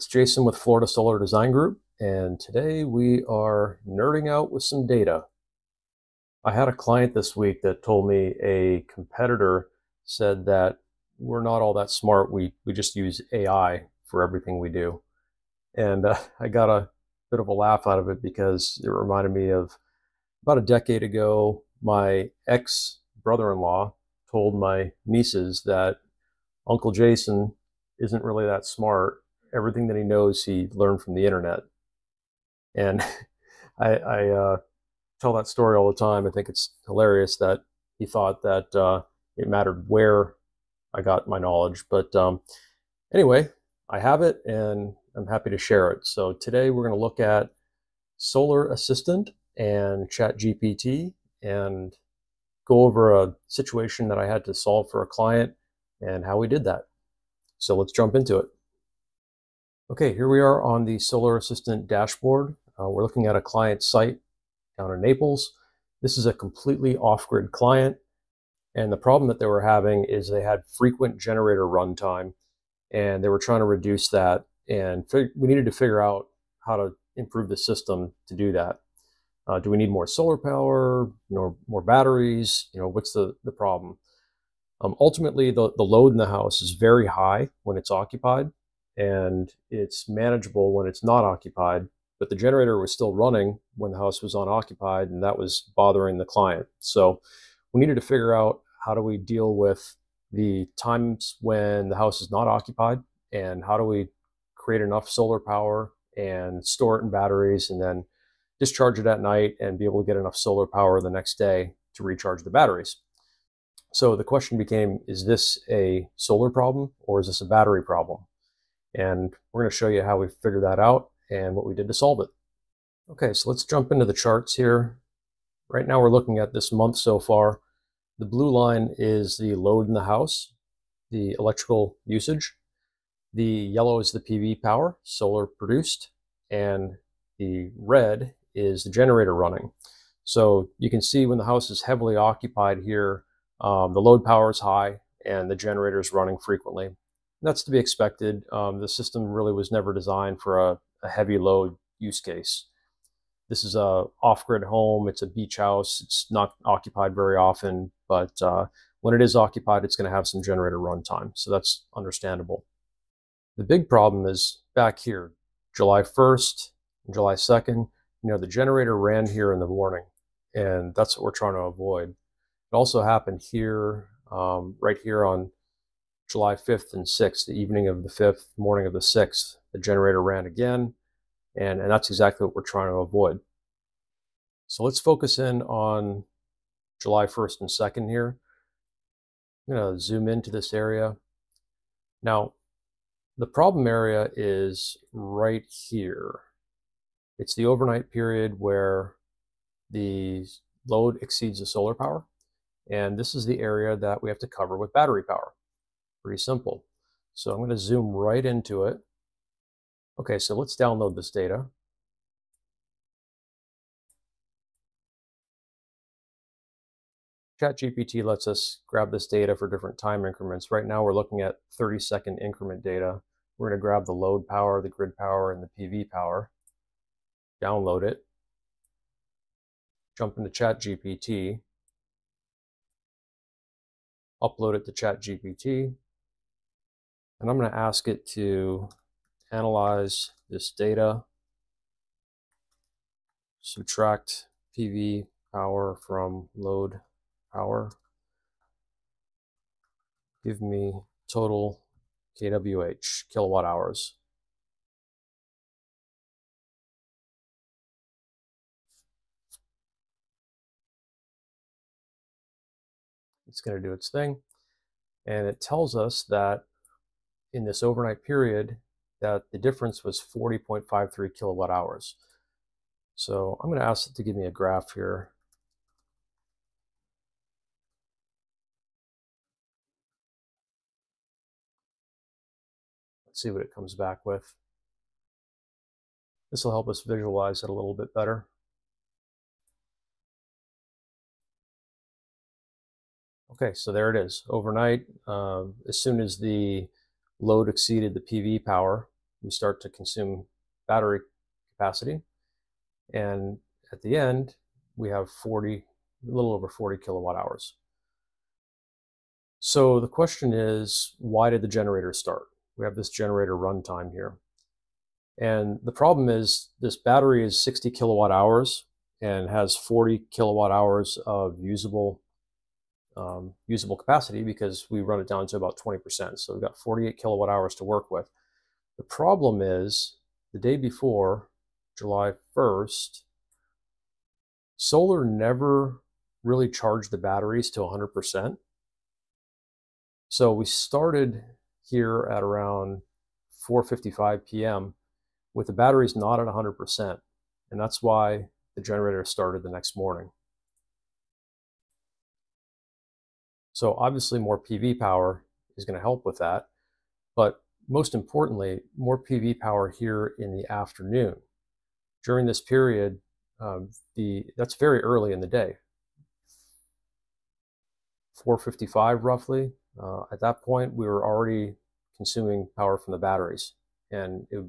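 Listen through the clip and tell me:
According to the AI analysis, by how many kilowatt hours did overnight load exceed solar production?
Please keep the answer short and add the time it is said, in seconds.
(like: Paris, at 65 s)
40.53, at 270 s.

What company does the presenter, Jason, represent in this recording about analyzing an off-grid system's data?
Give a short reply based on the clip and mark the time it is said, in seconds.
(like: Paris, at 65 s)
Florida Solar Design Group, at 0 s.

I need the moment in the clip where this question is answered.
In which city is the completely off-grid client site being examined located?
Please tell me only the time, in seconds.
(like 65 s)
65 s.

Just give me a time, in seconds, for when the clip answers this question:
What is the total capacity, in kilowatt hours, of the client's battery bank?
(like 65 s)
317 s.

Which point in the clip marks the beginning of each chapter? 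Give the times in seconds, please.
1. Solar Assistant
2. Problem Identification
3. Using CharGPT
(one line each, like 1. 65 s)
1. 59 s
2. 163 s
3. 233 s.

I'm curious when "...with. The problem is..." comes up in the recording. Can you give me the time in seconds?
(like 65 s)
328 s.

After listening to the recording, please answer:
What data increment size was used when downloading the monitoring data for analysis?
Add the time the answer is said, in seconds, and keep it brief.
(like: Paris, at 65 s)
30 seconds, at 221 s.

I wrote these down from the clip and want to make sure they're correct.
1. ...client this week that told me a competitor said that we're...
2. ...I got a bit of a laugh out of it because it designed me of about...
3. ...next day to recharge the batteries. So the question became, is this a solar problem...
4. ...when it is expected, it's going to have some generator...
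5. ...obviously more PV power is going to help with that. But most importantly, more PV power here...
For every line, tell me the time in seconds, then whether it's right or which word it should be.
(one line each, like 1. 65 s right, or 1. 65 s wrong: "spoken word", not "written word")
1. 6 s right
2. 16 s wrong: "reminded", not "designed"
3. 111 s right
4. 159 s wrong: "occupied", not "expected"
5. 353 s right.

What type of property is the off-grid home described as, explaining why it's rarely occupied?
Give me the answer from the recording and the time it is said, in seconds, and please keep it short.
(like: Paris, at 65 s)
Beach house, at 155 s.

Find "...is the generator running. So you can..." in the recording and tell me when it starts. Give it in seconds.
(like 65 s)
138 s.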